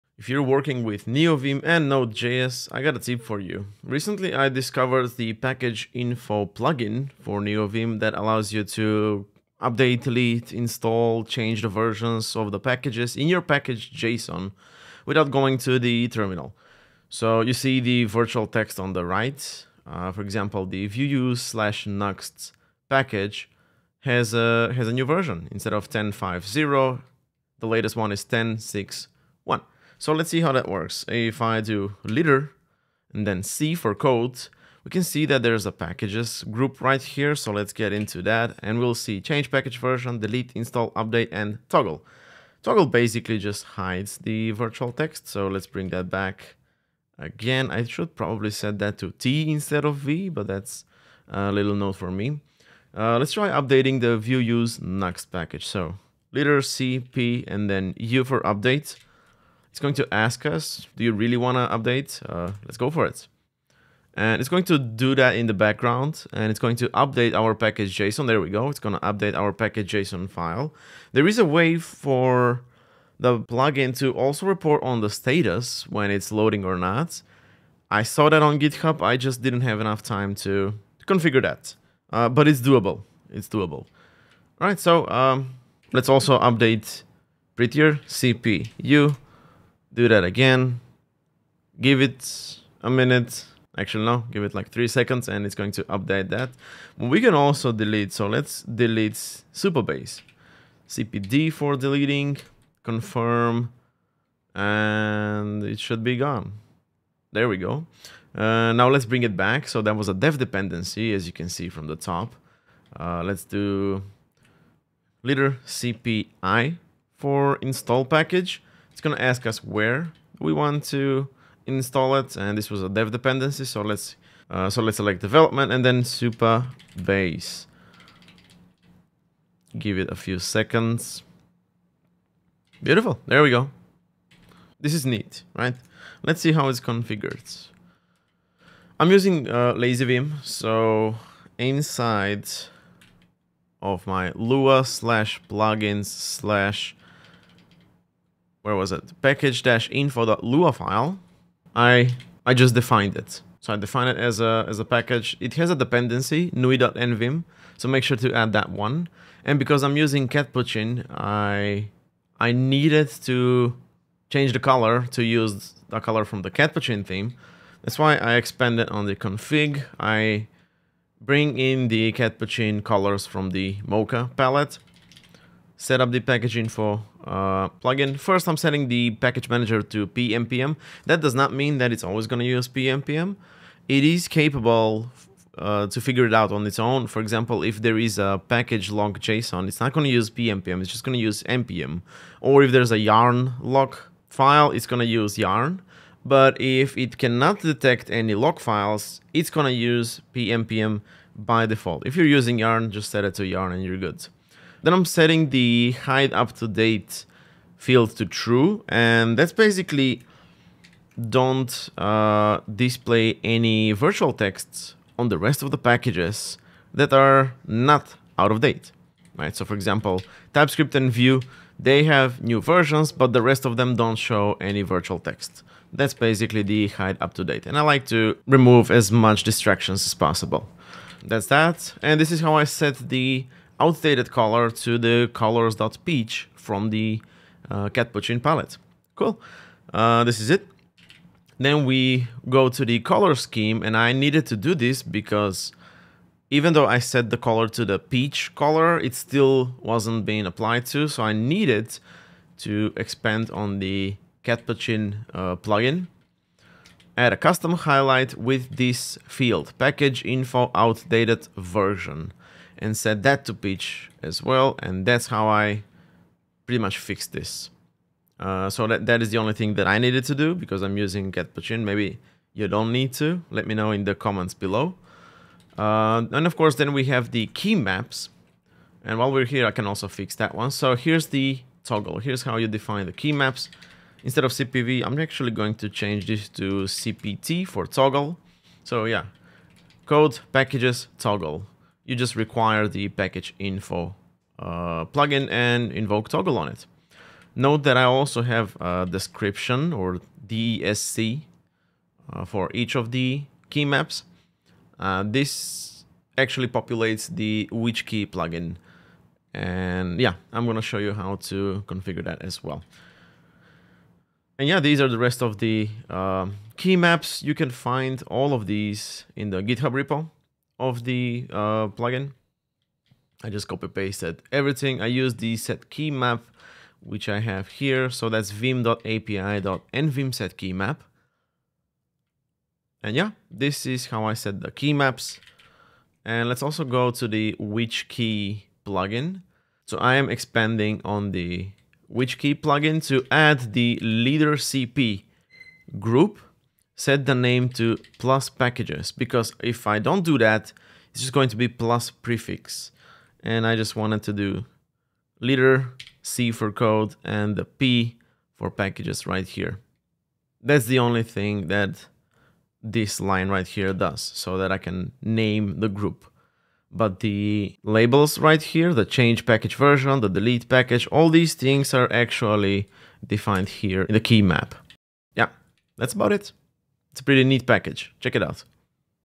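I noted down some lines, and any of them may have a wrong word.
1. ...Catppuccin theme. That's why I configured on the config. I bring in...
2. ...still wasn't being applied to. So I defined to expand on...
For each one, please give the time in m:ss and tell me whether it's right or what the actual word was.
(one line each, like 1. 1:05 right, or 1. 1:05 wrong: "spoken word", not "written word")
1. 2:46 wrong: "expanded", not "configured"
2. 4:09 wrong: "needed", not "defined".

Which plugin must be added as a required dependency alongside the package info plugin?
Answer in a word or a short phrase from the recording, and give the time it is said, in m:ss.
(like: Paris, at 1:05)
nui.nvim, at 2:36.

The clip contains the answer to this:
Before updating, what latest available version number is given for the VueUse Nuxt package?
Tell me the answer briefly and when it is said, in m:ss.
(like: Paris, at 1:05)
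10.6.1, at 0:28.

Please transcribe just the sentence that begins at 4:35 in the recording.
Uh, and of course, then we have the key maps.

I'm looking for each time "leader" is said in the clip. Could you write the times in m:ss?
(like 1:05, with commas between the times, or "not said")
0:32, 0:56, 1:55, 5:44, 5:55.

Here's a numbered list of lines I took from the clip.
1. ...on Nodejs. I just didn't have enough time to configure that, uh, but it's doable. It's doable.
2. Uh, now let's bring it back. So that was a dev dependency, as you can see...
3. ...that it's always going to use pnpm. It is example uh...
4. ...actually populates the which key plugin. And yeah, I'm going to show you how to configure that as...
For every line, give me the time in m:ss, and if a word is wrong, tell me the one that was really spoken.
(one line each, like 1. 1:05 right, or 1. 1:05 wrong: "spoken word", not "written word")
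1. 1:18 wrong: "GitHub", not "Nodejs"
2. 1:48 right
3. 3:01 wrong: "capable", not "example"
4. 5:06 right.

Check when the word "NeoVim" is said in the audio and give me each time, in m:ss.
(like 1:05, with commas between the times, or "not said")
0:01, 0:07.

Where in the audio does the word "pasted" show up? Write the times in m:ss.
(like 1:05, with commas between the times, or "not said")
5:23.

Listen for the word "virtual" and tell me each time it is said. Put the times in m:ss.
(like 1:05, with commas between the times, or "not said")
0:18, 0:44, 3:33, 3:44.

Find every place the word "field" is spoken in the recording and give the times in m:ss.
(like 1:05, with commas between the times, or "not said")
3:27, 4:19.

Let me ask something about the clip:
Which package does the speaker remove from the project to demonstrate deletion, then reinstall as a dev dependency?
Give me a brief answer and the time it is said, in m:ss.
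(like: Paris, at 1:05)
Supabase, at 1:39.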